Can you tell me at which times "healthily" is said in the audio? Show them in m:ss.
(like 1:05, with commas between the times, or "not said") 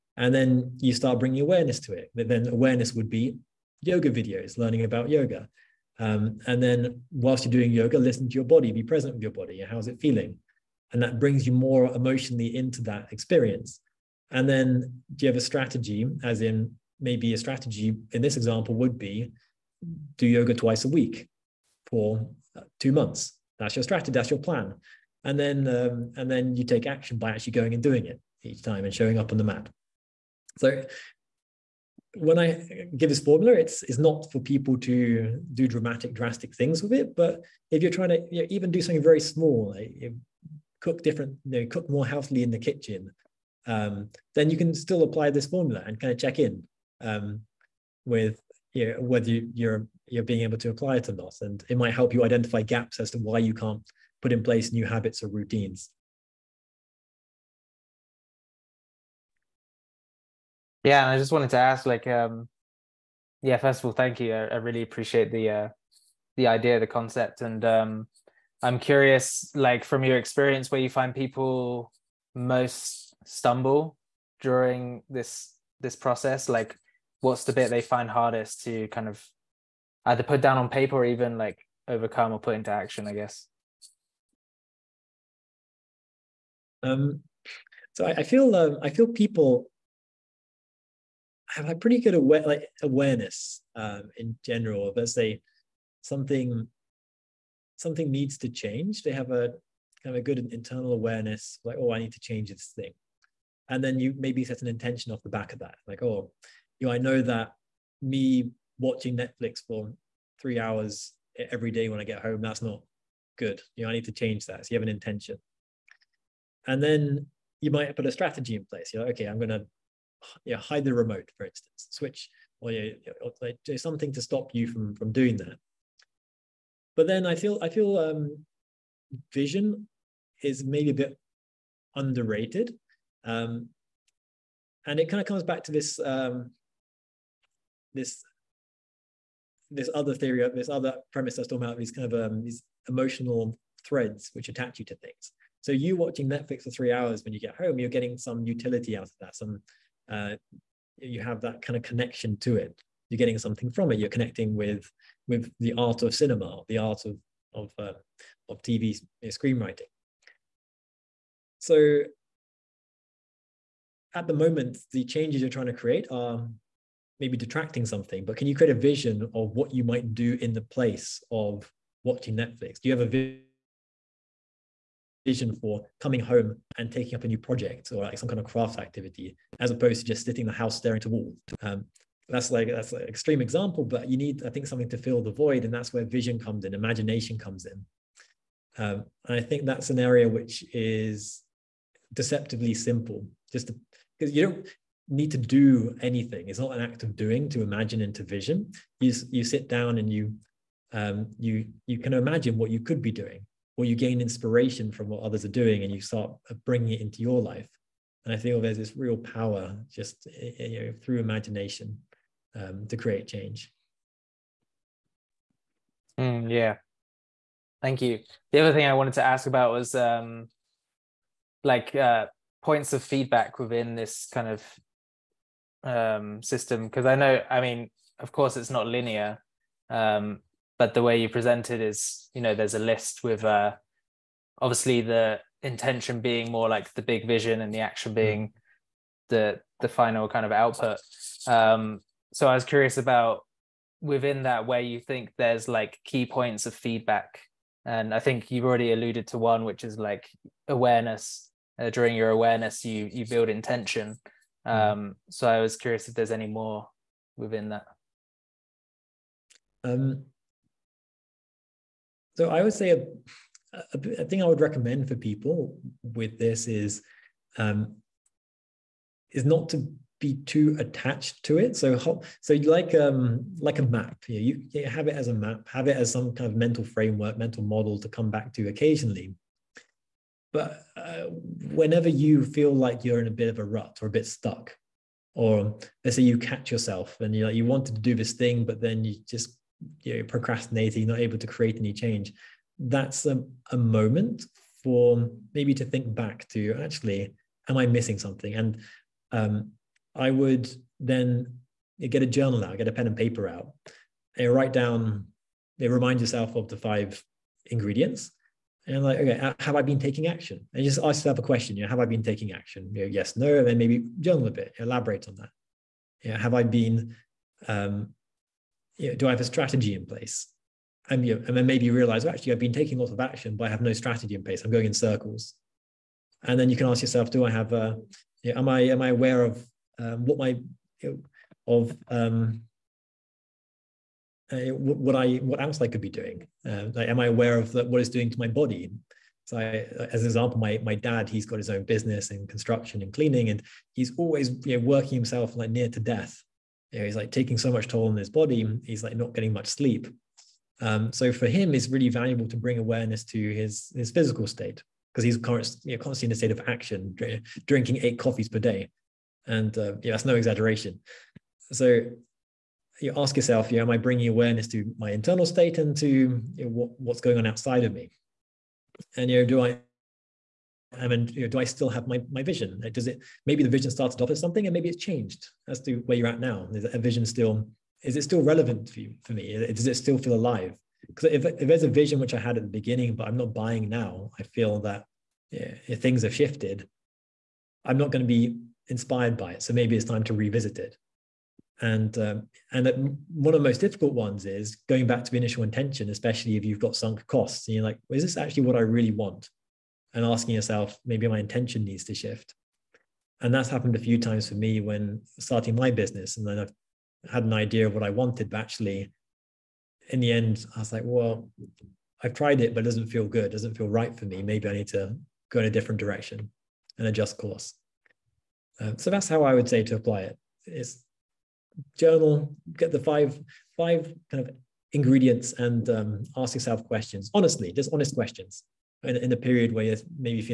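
0:42.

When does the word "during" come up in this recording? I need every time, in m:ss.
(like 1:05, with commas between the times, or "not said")
1:14, 4:11.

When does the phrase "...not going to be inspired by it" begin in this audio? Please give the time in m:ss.
6:27.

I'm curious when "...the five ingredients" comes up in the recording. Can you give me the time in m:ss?
5:06.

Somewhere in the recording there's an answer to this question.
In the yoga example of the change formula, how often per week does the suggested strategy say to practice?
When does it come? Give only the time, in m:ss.
0:20.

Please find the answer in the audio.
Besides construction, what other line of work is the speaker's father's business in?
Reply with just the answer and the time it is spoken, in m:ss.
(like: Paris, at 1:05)
cleaning, at 5:43.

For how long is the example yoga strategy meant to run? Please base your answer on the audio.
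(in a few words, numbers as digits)
two months.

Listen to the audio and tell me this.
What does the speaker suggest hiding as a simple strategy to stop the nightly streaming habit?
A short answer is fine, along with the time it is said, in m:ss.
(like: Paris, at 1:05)
the remote, at 2:00.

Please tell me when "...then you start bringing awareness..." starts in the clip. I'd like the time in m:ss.
0:00.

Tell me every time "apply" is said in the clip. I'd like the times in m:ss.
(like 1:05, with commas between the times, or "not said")
0:45, 0:50, 6:59.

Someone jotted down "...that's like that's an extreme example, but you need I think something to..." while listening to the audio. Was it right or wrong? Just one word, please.
right.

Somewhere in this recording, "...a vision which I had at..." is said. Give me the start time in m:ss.
6:21.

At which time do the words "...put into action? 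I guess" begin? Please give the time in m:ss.
1:22.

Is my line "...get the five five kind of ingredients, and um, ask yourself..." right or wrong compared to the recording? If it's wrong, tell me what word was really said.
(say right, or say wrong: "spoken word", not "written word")
right.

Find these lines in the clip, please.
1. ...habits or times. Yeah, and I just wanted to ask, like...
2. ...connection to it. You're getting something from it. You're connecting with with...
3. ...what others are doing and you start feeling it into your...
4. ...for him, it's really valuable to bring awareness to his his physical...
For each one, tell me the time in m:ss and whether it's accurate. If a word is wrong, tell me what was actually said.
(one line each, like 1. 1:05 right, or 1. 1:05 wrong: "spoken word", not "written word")
1. 0:54 wrong: "routines", not "times"
2. 2:31 right
3. 3:25 wrong: "bringing", not "feeling"
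4. 5:51 right.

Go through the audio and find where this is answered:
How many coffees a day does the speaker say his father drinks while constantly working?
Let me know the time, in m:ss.
5:58.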